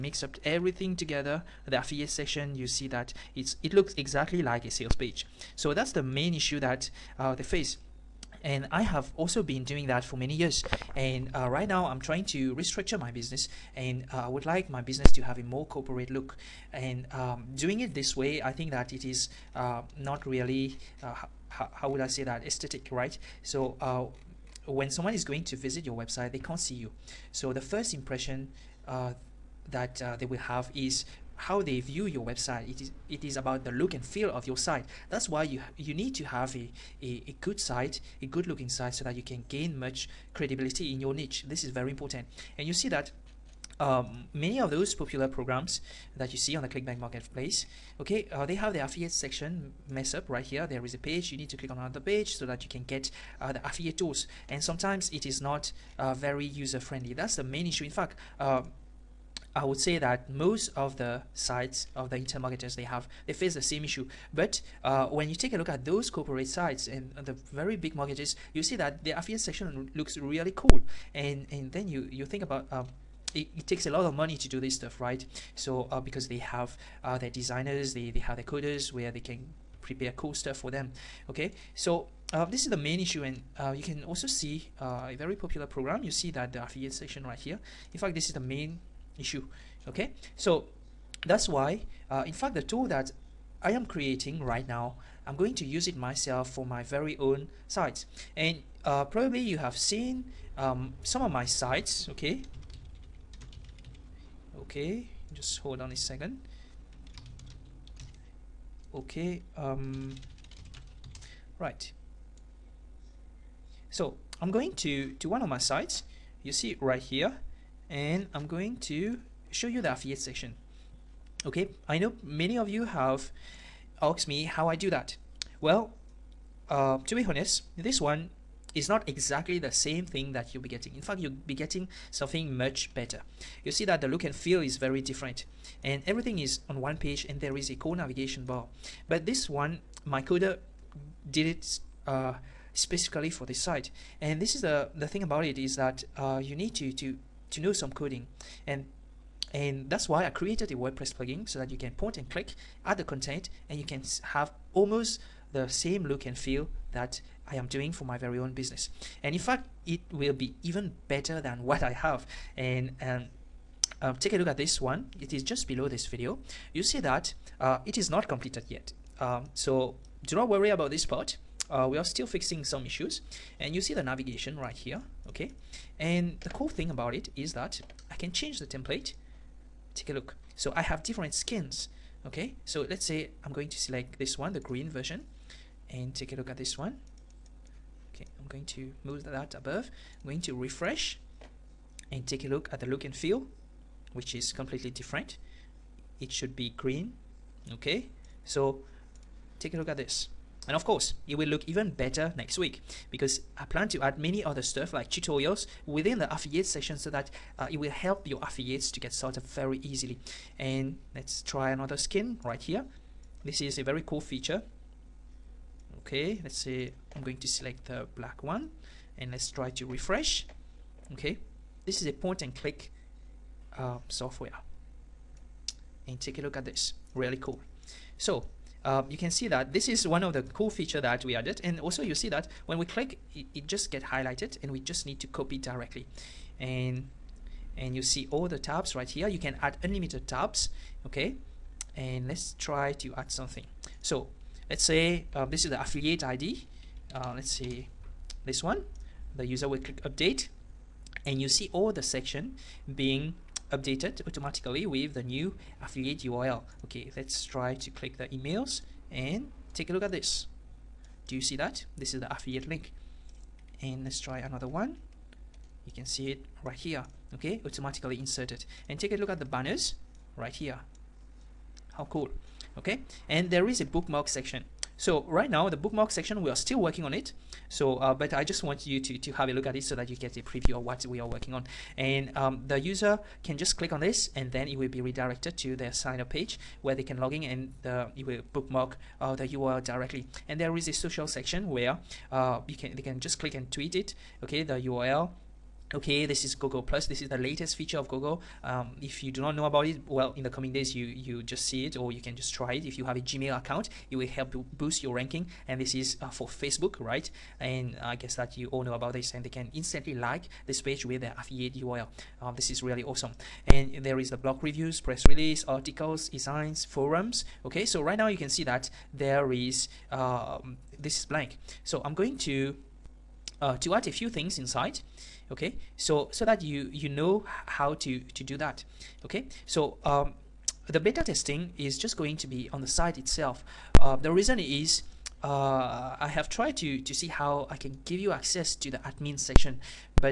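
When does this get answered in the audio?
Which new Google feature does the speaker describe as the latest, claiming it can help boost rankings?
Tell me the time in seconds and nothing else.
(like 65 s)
296 s.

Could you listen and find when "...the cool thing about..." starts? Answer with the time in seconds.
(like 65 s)
176 s.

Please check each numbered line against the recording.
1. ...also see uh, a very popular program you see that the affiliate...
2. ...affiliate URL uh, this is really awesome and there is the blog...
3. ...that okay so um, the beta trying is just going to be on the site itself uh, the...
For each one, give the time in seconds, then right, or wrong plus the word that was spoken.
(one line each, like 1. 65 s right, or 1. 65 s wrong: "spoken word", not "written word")
1. 84 s right
2. 311 s right
3. 328 s wrong: "testing", not "trying".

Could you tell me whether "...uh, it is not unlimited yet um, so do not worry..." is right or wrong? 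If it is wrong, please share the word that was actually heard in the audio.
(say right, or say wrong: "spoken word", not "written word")
wrong: "completed", not "unlimited".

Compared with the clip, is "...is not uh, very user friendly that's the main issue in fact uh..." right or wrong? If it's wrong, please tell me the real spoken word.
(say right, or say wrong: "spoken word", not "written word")
right.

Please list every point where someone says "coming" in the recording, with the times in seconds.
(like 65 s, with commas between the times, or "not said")
300 s.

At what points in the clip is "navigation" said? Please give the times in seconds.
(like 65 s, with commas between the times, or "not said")
137 s, 174 s.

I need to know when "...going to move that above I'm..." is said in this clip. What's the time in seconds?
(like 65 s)
188 s.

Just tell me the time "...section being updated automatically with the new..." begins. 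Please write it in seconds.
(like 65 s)
252 s.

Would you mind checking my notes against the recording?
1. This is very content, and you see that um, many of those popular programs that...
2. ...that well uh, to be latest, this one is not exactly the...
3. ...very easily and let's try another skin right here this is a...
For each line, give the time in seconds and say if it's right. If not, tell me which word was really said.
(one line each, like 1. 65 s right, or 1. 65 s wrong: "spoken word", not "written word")
1. 41 s wrong: "important", not "content"
2. 124 s wrong: "honest", not "latest"
3. 209 s right.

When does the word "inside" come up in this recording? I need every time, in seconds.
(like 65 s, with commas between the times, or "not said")
324 s.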